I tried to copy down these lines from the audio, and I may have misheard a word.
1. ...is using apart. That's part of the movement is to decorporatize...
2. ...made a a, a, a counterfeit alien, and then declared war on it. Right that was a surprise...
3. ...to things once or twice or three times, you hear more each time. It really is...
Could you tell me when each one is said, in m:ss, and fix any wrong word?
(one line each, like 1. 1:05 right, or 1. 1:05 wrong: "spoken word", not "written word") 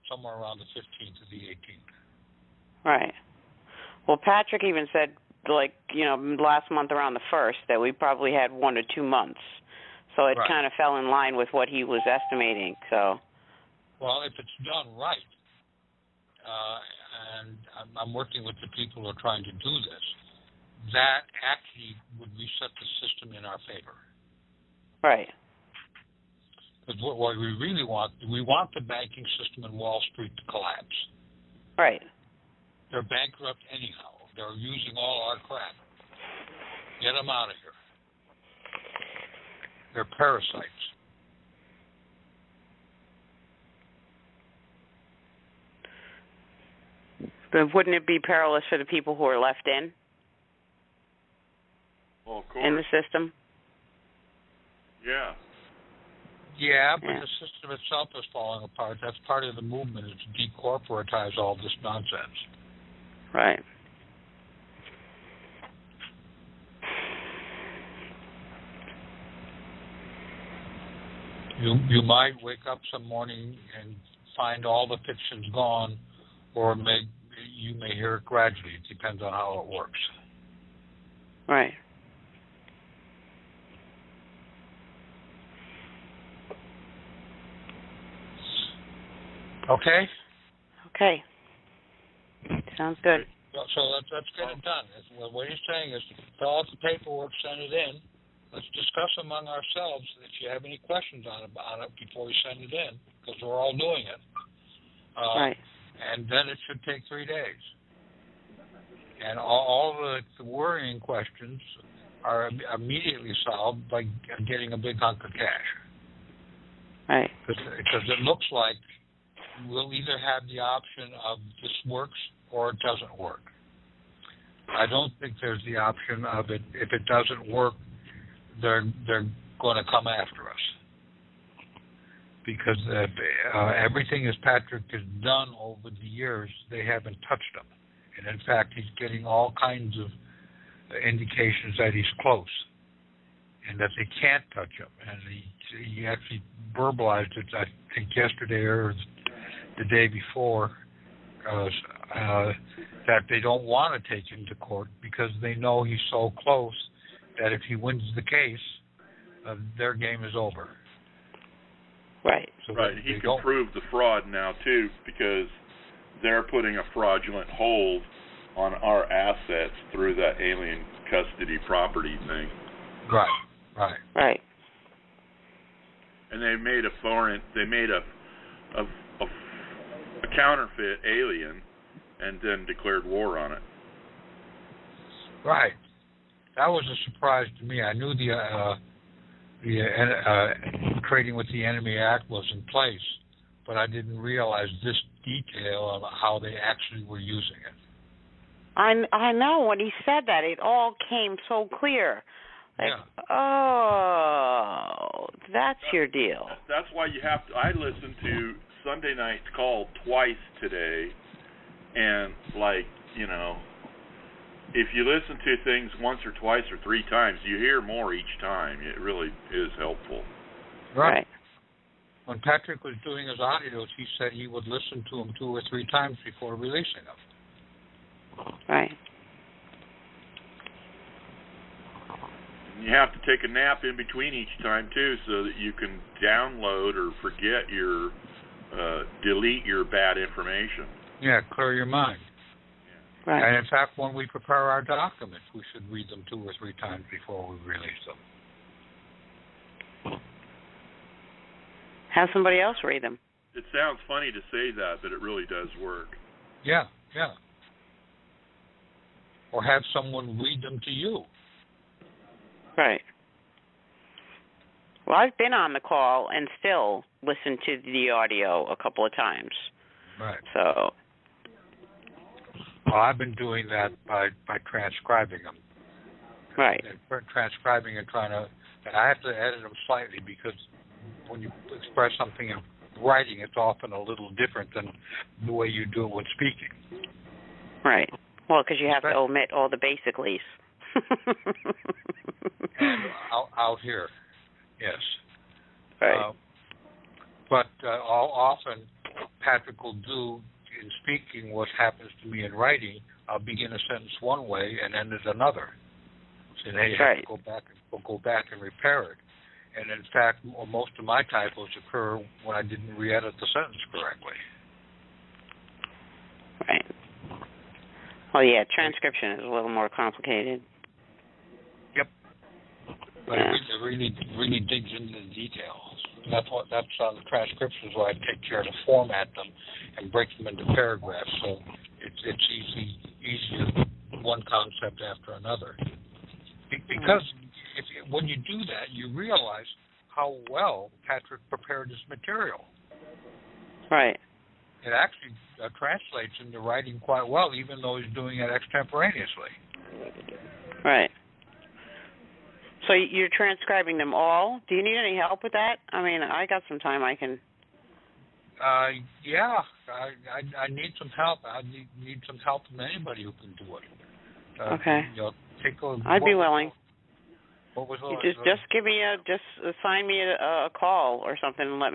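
1. 0:58 wrong: "falling", not "using"
2. 2:57 right
3. 3:35 right.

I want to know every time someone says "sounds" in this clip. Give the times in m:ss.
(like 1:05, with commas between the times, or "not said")
1:32, 4:13.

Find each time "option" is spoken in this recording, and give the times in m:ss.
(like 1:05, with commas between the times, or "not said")
2:00, 2:05.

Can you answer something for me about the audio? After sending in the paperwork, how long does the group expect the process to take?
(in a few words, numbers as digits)
three days.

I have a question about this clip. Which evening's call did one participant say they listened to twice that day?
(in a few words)
Sunday night.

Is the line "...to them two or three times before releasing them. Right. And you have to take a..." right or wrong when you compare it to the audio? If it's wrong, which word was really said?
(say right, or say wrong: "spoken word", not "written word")
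right.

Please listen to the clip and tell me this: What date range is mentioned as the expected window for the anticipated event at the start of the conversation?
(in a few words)
15th to the 18th.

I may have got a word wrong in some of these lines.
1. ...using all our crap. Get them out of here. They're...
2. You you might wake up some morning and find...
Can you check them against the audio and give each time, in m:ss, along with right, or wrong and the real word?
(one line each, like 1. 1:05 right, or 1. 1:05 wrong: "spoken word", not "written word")
1. 0:34 right
2. 1:11 right.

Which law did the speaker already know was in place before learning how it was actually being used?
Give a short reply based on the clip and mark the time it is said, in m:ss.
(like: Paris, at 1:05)
Trading with the Enemy Act, at 3:11.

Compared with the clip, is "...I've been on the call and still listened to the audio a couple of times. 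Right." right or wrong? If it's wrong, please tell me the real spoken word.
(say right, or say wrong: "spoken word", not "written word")
right.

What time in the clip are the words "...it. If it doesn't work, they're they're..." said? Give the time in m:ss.
2:06.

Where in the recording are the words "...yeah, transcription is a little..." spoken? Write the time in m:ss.
5:18.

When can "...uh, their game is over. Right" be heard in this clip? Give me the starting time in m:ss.
2:39.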